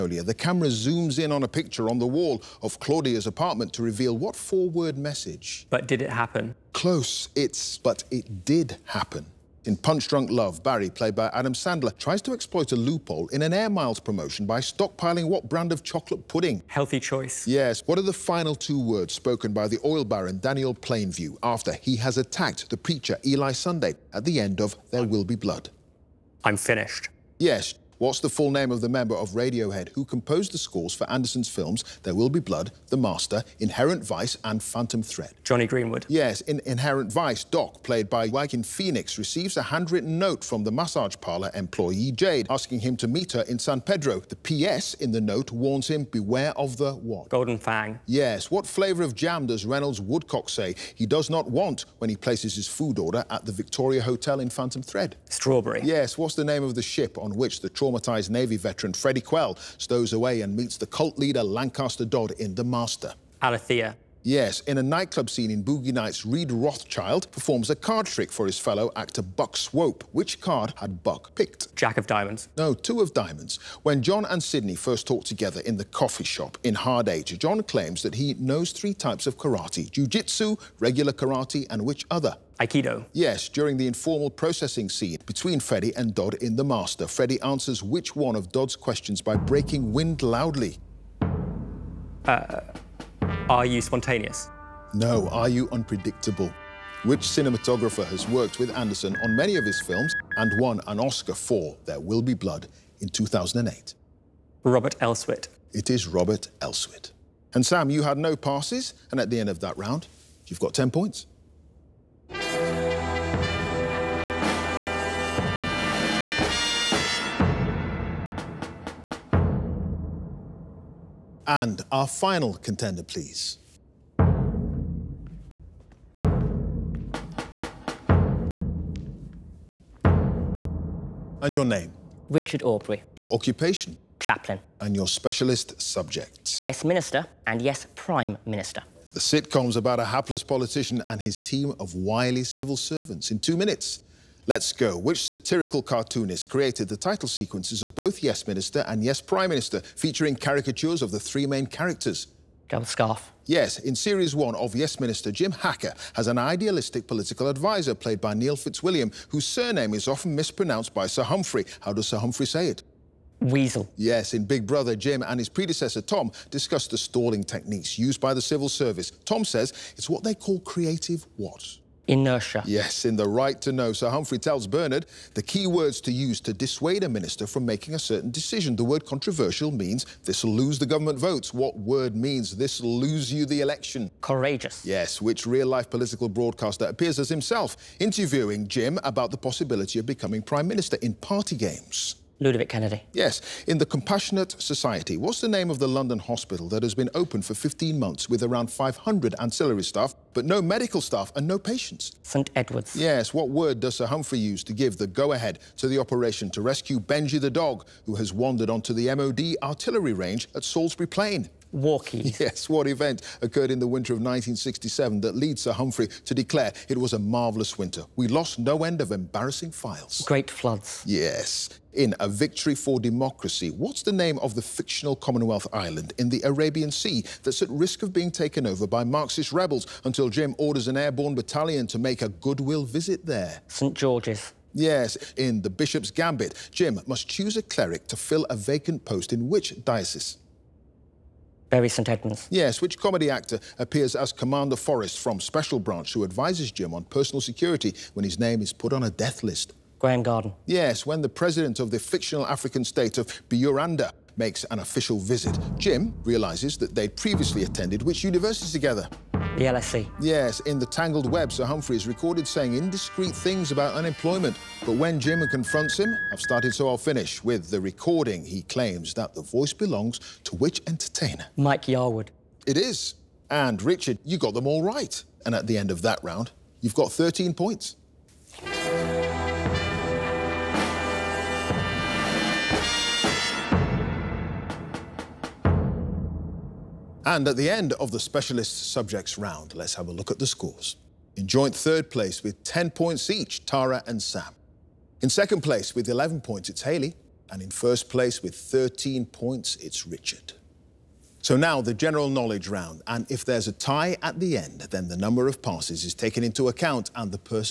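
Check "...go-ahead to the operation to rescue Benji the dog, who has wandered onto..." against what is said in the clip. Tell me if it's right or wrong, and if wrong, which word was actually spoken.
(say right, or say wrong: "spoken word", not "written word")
right.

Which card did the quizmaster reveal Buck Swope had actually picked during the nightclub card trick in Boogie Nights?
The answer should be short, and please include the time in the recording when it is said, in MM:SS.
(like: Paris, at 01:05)
Two of Diamonds, at 01:12.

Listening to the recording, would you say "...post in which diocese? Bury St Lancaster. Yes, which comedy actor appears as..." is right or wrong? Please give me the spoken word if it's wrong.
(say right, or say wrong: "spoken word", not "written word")
wrong: "Edmunds", not "Lancaster".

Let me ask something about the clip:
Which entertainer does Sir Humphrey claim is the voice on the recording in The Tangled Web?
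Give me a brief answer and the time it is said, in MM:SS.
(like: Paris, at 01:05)
Mike Yarwood, at 04:31.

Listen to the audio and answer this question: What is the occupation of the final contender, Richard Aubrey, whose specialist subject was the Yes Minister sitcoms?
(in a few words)
Chaplain.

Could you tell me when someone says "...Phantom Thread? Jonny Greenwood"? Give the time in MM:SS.
00:34.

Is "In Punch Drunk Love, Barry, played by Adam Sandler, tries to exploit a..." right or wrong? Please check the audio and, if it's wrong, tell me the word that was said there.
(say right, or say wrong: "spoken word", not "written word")
right.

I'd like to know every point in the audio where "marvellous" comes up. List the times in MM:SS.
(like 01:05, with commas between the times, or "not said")
03:37.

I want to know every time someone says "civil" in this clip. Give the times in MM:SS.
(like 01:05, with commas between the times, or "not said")
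02:22, 02:48.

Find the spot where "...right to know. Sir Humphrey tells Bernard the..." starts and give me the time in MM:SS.
02:53.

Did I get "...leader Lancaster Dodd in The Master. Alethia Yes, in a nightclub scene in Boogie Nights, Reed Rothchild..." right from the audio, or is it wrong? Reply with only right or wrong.
right.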